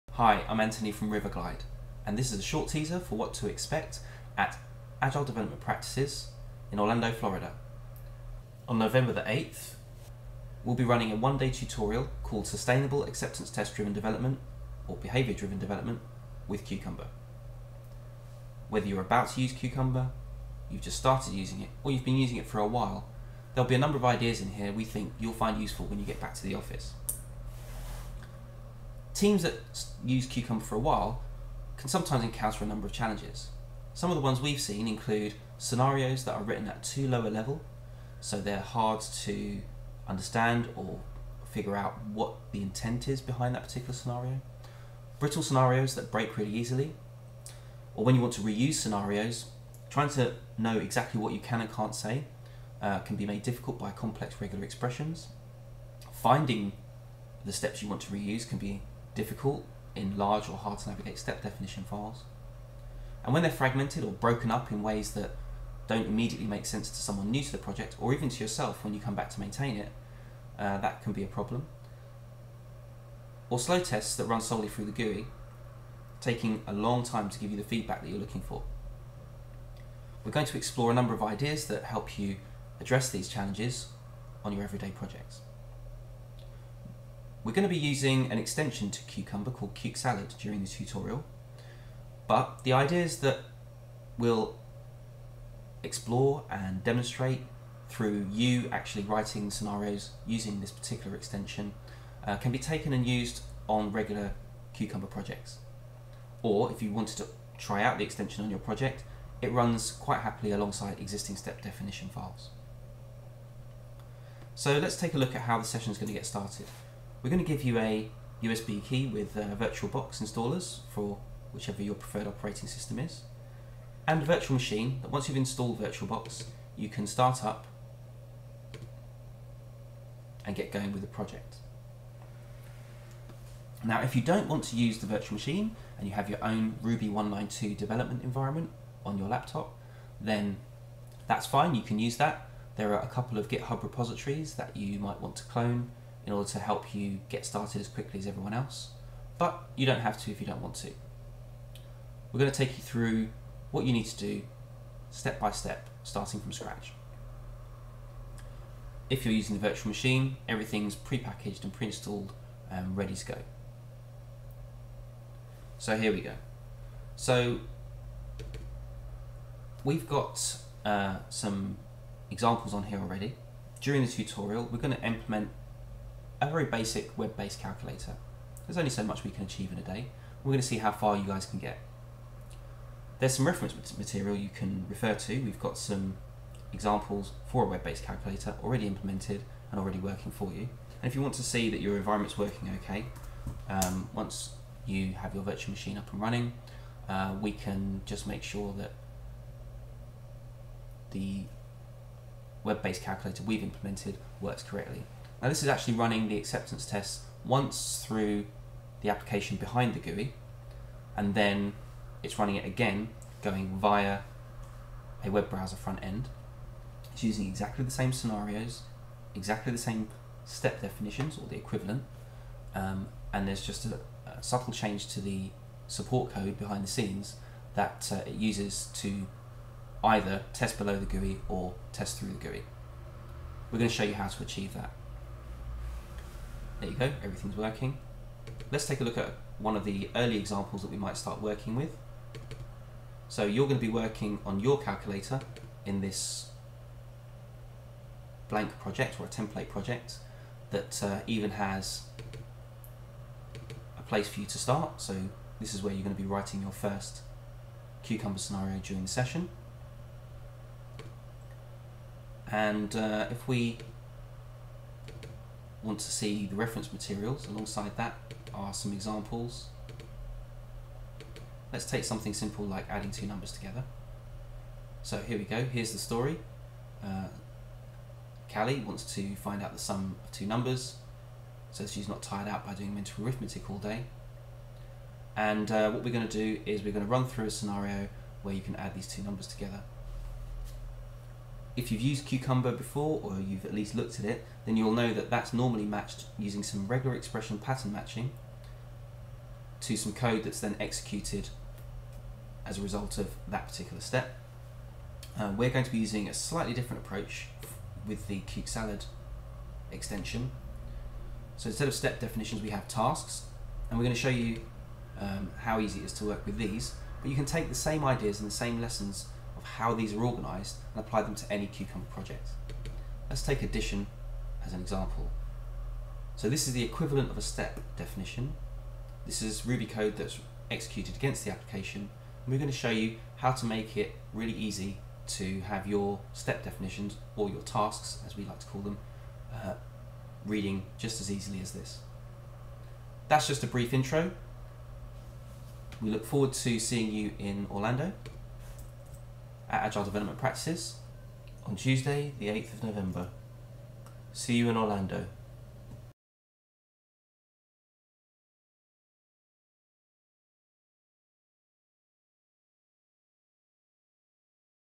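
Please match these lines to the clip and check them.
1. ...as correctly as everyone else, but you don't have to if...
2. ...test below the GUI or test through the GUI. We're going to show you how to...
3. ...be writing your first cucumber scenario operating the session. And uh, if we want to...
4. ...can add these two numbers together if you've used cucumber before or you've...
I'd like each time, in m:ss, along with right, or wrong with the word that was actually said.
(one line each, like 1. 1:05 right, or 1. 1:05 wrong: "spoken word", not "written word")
1. 2:27 wrong: "quickly", not "correctly"
2. 3:50 right
3. 4:16 wrong: "during", not "operating"
4. 4:48 right.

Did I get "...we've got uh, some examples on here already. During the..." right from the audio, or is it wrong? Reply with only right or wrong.
right.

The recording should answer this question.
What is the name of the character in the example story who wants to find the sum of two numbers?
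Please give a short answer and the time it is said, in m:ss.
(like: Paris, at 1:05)
Callie, at 4:38.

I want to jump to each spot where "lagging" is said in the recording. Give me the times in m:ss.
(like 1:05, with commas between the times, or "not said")
not said.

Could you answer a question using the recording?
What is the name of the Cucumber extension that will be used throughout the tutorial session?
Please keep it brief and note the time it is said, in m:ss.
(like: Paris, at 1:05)
Cuke Salad, at 1:29.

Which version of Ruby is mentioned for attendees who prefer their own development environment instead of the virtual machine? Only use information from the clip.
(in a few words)
1.9.2.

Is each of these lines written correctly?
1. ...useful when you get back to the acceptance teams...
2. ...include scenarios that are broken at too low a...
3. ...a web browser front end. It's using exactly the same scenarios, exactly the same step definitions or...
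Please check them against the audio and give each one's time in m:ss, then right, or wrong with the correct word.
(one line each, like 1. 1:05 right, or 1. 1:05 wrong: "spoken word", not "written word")
1. 0:25 wrong: "office", not "acceptance"
2. 0:34 wrong: "written", not "broken"
3. 3:35 right.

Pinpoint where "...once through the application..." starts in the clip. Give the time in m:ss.
3:27.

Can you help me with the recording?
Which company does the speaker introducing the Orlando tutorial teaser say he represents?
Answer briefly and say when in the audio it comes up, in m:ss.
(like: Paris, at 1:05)
Riverglide, at 0:01.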